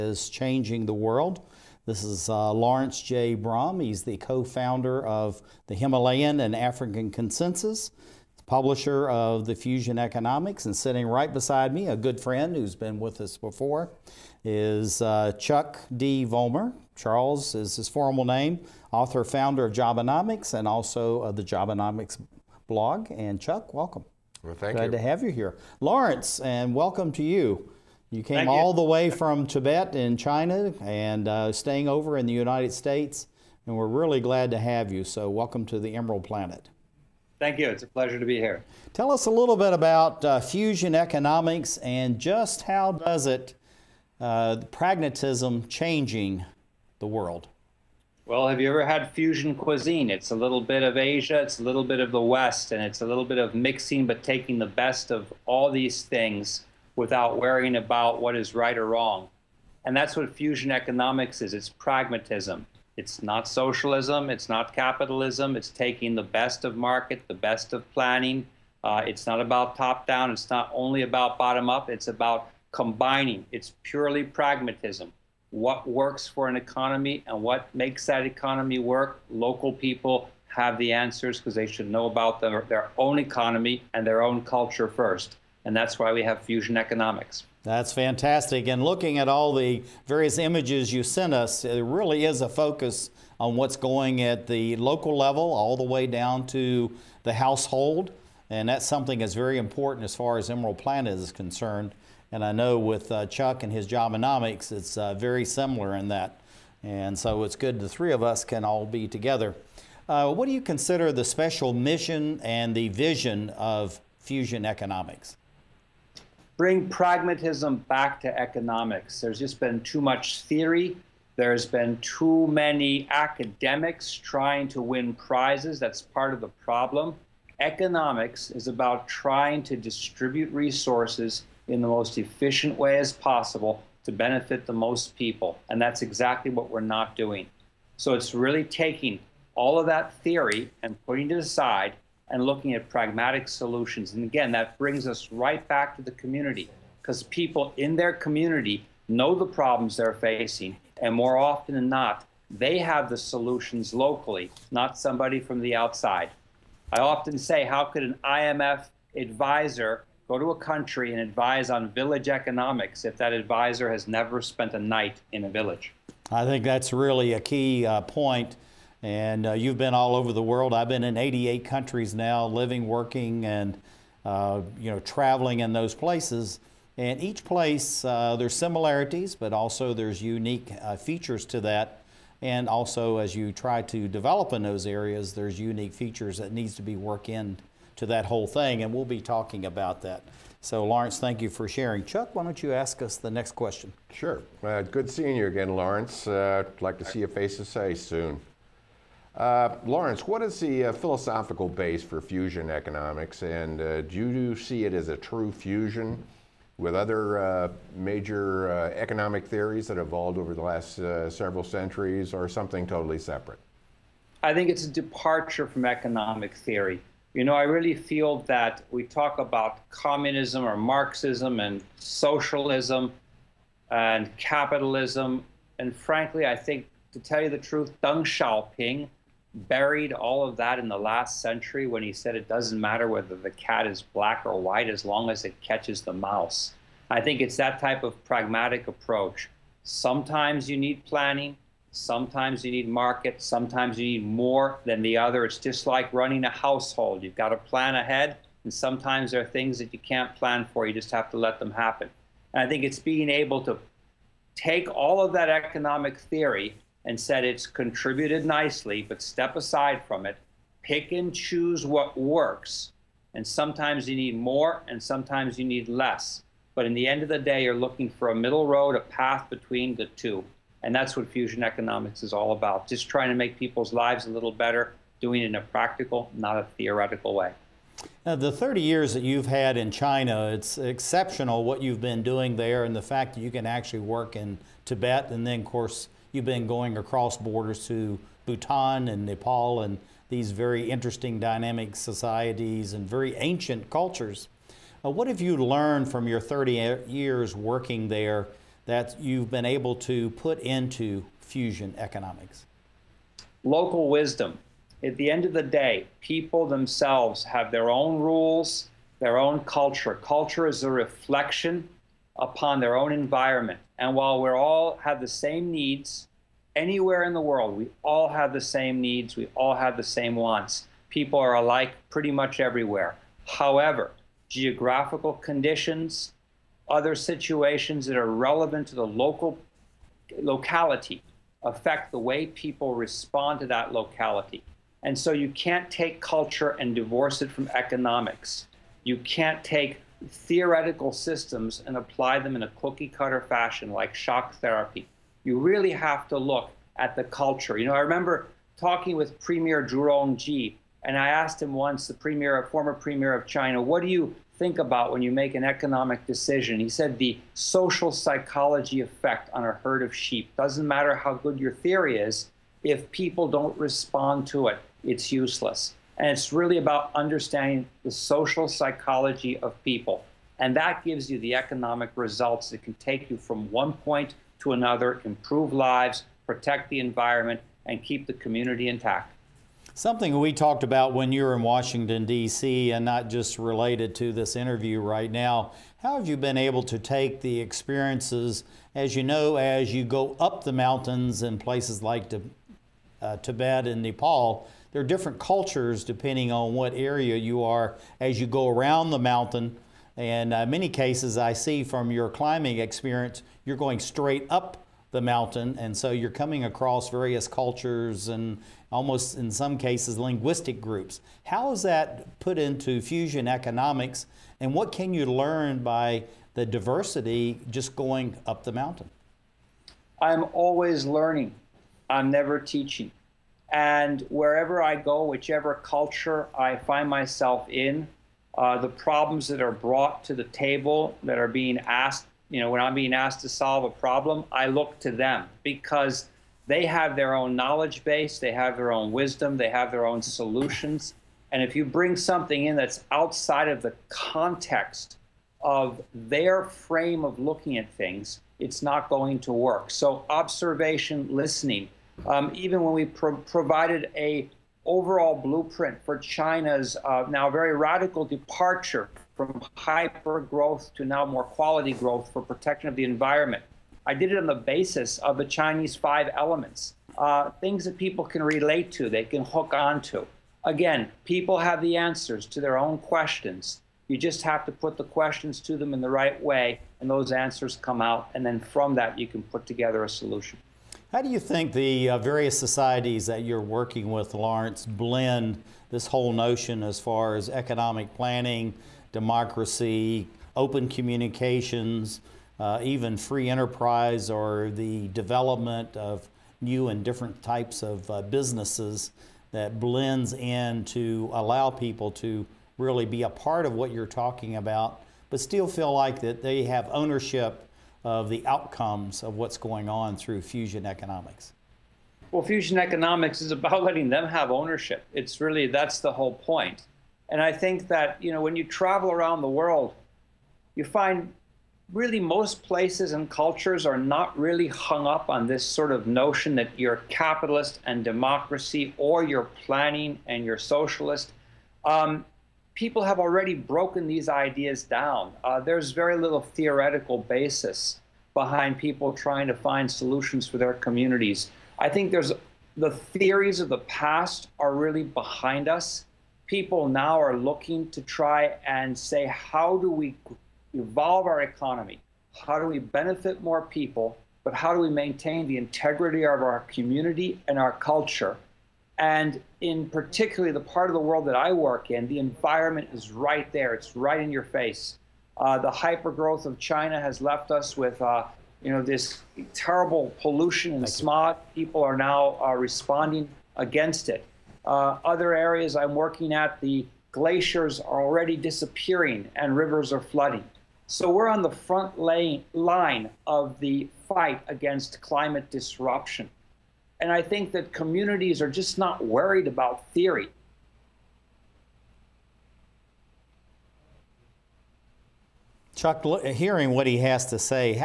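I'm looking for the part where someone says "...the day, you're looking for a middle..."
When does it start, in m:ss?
4:27.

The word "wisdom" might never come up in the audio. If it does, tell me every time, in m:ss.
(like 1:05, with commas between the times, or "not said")
5:04, 7:19.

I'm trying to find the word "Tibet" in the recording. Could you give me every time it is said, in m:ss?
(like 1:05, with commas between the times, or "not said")
0:29, 4:44, 6:33.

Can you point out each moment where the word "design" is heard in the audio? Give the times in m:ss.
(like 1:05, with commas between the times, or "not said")
not said.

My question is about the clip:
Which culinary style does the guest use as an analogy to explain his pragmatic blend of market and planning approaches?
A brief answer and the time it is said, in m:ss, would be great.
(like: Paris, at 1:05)
Fusion cuisine, at 0:49.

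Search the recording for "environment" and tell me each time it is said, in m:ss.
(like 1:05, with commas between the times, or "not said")
5:13, 6:16, 7:43, 9:22.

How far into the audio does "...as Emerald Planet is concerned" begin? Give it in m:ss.
1:40.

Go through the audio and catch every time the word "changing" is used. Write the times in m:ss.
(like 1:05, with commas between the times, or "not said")
0:00, 0:45.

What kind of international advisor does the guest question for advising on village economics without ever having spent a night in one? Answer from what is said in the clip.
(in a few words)
IMF advisor.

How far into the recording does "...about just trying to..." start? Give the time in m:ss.
4:32.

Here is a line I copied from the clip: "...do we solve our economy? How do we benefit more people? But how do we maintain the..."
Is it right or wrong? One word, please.
wrong.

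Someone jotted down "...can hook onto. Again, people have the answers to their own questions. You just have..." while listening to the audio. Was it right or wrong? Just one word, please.
right.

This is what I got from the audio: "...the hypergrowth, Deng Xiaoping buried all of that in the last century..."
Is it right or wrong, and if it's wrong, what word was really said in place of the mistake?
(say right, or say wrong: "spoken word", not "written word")
wrong: "truth", not "hypergrowth".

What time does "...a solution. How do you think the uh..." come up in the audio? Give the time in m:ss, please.
8:00.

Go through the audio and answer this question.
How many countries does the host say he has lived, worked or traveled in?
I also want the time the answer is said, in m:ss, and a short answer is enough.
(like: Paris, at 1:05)
88, at 2:51.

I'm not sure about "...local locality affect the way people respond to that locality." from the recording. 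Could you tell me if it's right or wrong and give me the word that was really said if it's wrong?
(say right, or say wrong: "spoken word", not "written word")
right.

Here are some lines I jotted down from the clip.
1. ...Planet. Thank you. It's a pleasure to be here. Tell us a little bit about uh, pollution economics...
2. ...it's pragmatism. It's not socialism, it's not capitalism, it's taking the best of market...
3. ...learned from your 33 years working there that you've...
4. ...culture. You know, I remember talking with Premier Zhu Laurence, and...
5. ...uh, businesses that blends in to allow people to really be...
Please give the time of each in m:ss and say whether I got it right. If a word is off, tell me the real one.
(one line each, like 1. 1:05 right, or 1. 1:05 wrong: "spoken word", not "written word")
1. 0:36 wrong: "fusion", not "pollution"
2. 1:01 right
3. 4:55 wrong: "30", not "33"
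4. 5:47 wrong: "Rongji", not "Laurence"
5. 8:18 right.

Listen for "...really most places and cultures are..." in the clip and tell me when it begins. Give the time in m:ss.
8:41.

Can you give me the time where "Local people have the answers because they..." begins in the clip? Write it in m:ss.
1:19.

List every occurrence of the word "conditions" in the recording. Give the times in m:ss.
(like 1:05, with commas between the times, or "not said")
5:25.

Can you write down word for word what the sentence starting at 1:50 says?
Uh, what do you consider the special mission and the vision of Fusion Economics?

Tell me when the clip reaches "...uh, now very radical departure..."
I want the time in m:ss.
7:37.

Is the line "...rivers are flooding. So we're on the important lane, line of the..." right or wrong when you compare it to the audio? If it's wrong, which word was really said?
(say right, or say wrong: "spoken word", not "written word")
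wrong: "front", not "important".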